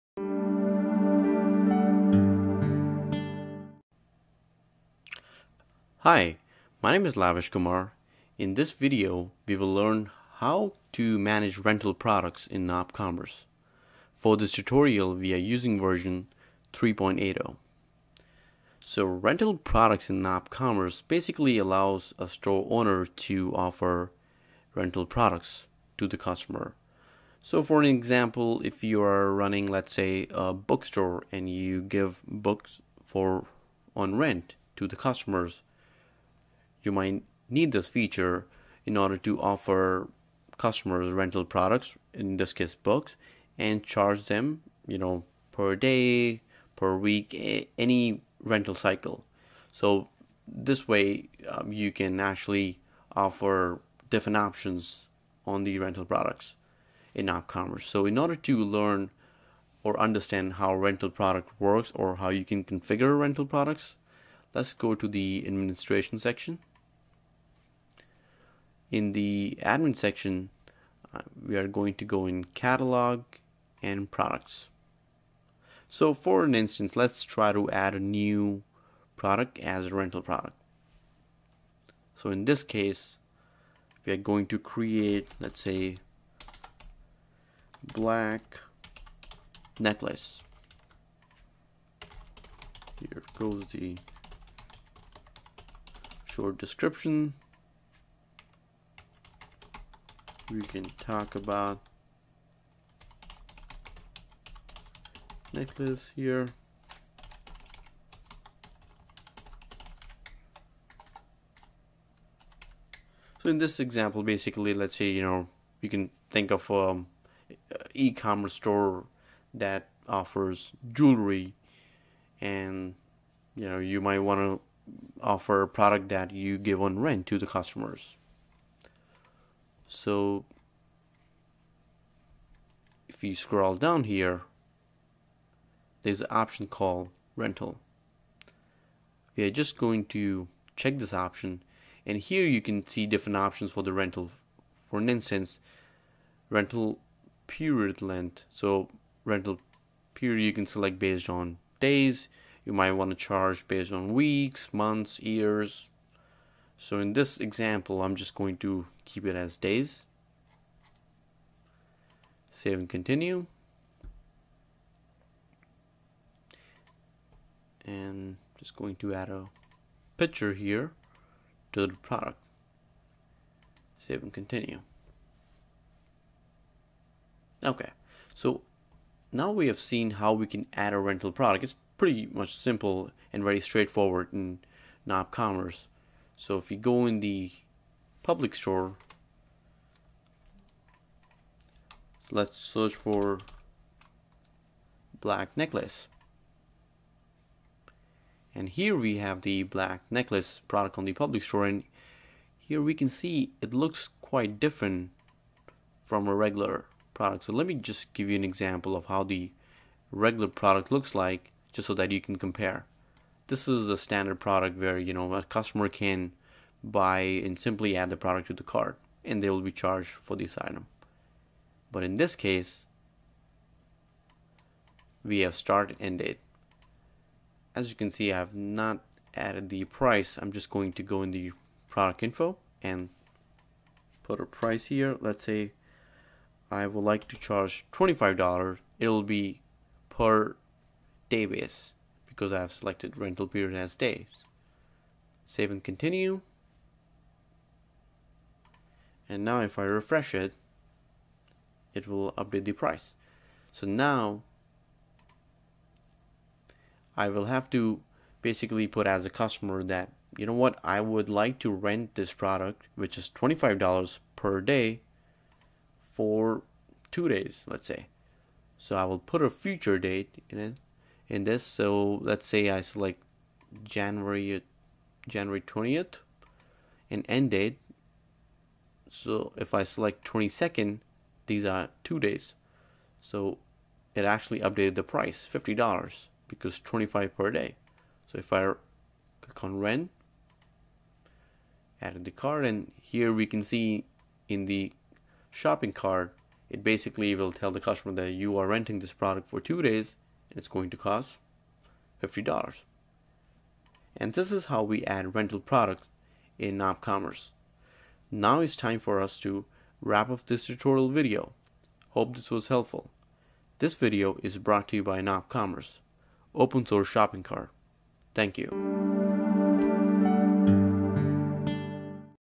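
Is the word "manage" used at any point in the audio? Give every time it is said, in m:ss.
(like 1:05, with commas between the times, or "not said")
0:11.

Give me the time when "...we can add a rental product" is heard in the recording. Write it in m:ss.
3:00.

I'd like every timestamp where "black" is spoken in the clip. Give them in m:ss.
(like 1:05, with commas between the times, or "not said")
1:27, 3:15, 3:19.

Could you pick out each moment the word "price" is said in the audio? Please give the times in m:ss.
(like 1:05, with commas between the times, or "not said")
3:49, 3:54, 4:12, 4:45.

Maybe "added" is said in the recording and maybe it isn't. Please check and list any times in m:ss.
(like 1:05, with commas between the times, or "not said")
3:49, 4:52.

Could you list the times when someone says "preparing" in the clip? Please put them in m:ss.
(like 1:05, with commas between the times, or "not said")
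not said.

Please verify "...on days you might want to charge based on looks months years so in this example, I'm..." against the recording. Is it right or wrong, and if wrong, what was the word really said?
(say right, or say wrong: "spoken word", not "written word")
wrong: "weeks", not "looks".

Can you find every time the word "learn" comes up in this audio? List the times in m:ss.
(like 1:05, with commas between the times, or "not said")
0:09, 0:58.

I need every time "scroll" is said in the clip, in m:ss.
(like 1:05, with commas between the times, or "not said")
2:13.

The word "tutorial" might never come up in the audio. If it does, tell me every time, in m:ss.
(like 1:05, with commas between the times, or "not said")
0:14, 5:10.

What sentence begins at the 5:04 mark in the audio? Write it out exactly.
And this is how we add rental products in NopCommerce.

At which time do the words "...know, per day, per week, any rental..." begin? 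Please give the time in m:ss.
0:44.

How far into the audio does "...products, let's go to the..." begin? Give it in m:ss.
1:03.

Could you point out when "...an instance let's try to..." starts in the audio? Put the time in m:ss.
1:16.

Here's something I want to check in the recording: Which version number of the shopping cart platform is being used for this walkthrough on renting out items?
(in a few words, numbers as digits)
3.80.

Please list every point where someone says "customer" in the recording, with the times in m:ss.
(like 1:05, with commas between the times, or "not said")
0:26, 0:34, 0:40, 2:07, 3:35, 4:19, 4:57.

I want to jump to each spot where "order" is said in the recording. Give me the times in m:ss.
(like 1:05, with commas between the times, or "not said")
0:38, 0:58.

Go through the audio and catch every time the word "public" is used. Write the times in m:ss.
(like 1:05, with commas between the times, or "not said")
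3:08, 3:21.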